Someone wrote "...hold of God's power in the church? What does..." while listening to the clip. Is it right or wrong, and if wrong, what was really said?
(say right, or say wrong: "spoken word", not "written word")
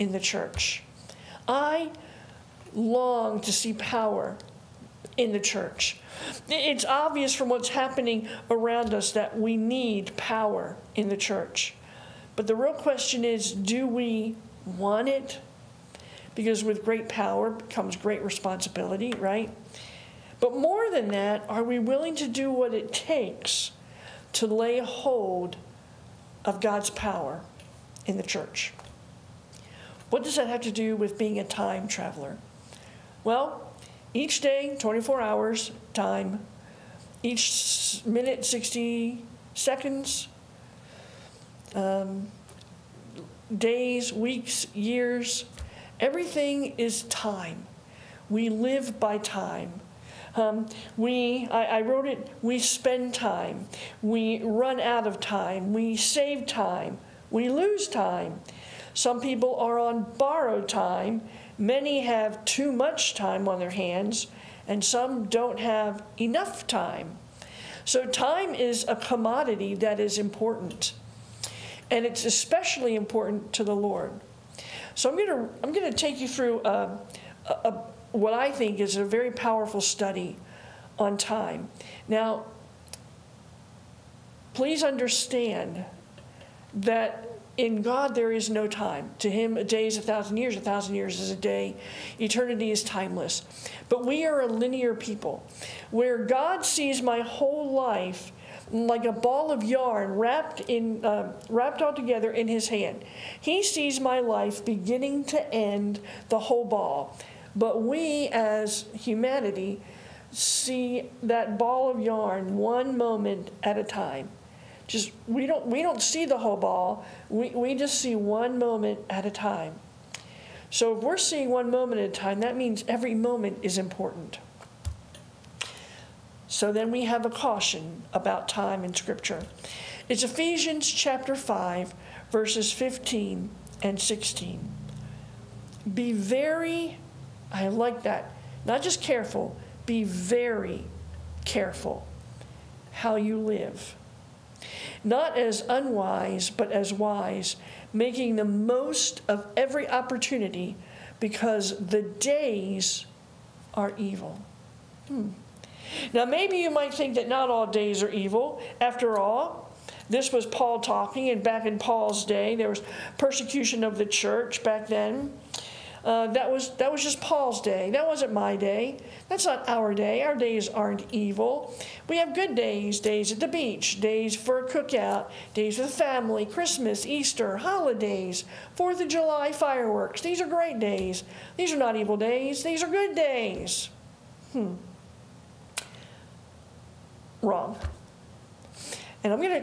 right.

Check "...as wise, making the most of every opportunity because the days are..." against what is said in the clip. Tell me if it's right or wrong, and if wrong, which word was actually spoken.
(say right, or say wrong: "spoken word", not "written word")
right.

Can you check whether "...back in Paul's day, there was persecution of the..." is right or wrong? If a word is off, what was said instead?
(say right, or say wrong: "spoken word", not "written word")
right.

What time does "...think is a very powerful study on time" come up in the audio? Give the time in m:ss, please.
1:18.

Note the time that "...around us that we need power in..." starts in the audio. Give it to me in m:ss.
0:08.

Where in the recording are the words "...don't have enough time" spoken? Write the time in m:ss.
1:05.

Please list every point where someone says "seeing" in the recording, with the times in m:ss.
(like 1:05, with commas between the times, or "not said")
2:01.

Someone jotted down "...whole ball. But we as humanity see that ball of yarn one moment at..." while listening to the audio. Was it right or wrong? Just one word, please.
right.